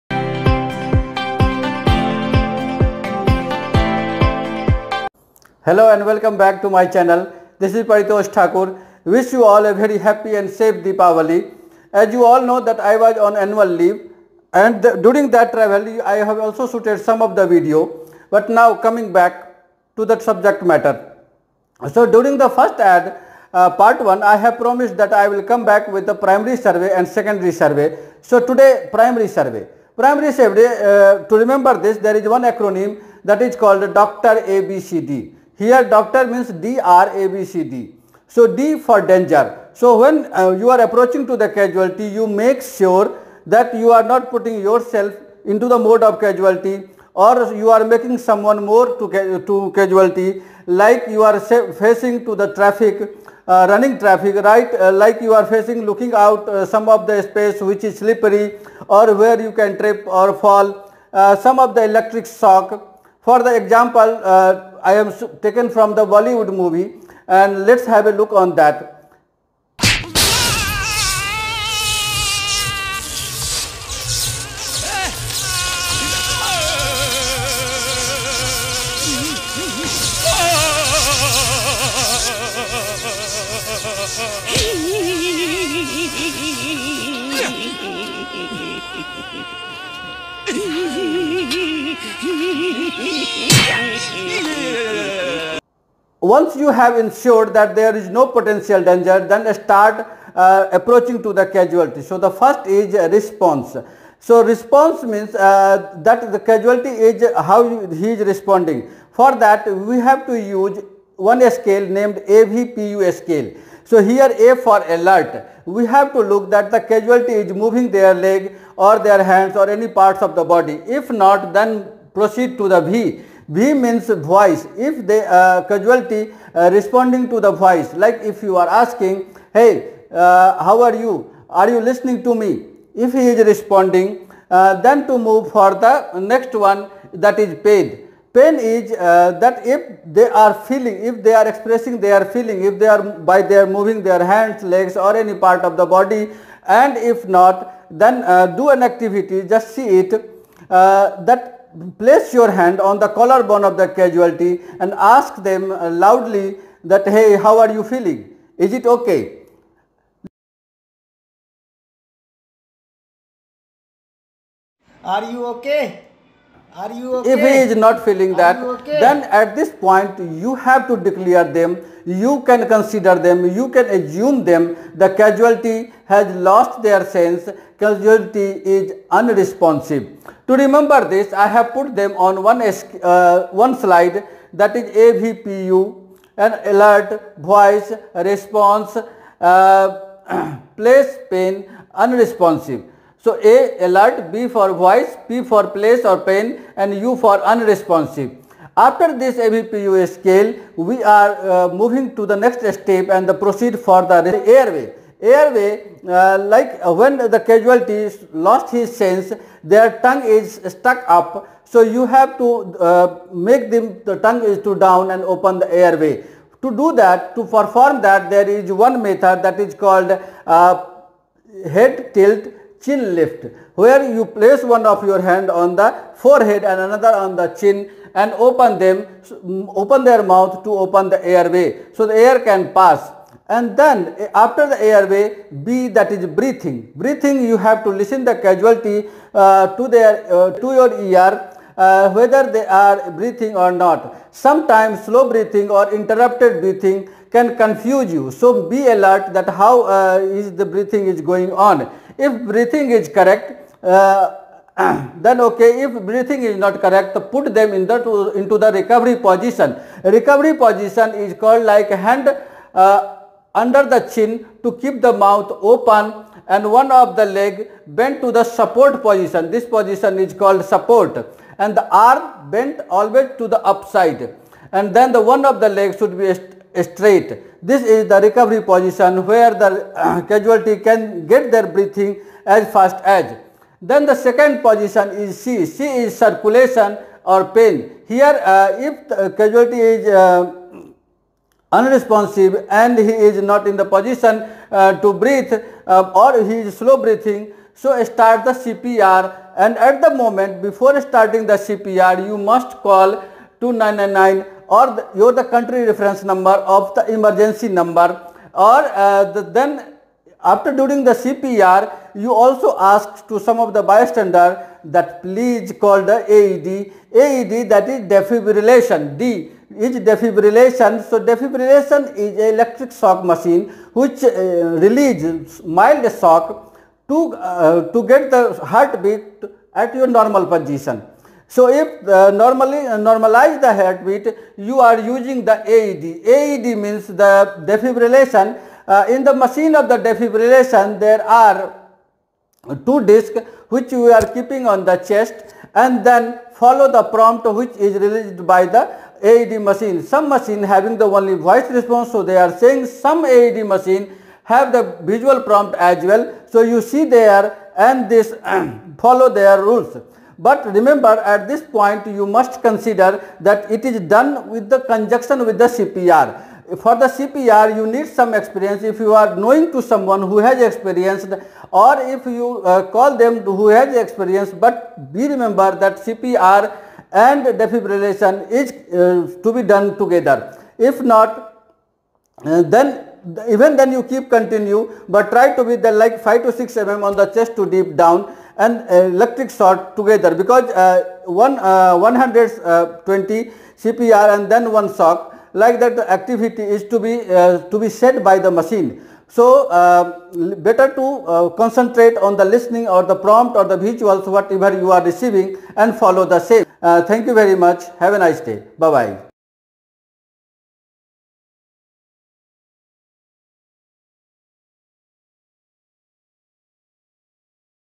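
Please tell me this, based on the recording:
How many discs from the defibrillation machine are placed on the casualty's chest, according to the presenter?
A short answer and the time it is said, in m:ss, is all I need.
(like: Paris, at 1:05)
2, at 5:42.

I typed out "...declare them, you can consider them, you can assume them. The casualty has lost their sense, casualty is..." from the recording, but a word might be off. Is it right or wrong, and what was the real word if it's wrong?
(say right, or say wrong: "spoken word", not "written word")
right.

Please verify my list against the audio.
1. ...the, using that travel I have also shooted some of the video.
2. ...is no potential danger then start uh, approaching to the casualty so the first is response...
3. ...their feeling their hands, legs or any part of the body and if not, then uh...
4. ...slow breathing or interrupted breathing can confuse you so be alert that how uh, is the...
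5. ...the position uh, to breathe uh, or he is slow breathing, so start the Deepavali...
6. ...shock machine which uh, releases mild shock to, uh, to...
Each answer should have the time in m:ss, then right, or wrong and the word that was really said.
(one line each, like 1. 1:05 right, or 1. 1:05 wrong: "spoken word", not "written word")
1. 0:14 wrong: "during", not "using"
2. 1:37 right
3. 2:23 wrong: "moving", not "feeling"
4. 4:05 right
5. 4:53 wrong: "CPR", not "Deepavali"
6. 5:22 right.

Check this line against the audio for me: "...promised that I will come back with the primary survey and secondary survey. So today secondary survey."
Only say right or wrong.
wrong.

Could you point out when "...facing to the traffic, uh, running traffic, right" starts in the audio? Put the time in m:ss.
0:51.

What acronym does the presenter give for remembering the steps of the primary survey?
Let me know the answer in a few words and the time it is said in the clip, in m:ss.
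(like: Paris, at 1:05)
Dr. ABCD, at 0:33.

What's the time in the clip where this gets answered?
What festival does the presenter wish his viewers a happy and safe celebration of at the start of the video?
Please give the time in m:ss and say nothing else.
0:10.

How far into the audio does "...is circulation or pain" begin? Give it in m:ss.
4:46.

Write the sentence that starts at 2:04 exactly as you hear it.
If the uh, casualty uh, responding to the voice, like if you are asking, hey, uh, how are you?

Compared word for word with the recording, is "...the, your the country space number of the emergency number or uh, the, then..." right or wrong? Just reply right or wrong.
wrong.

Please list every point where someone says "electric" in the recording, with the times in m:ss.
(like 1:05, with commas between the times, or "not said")
1:01, 5:22, 6:29.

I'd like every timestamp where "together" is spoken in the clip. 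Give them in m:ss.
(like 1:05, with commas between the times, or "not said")
6:19, 6:29.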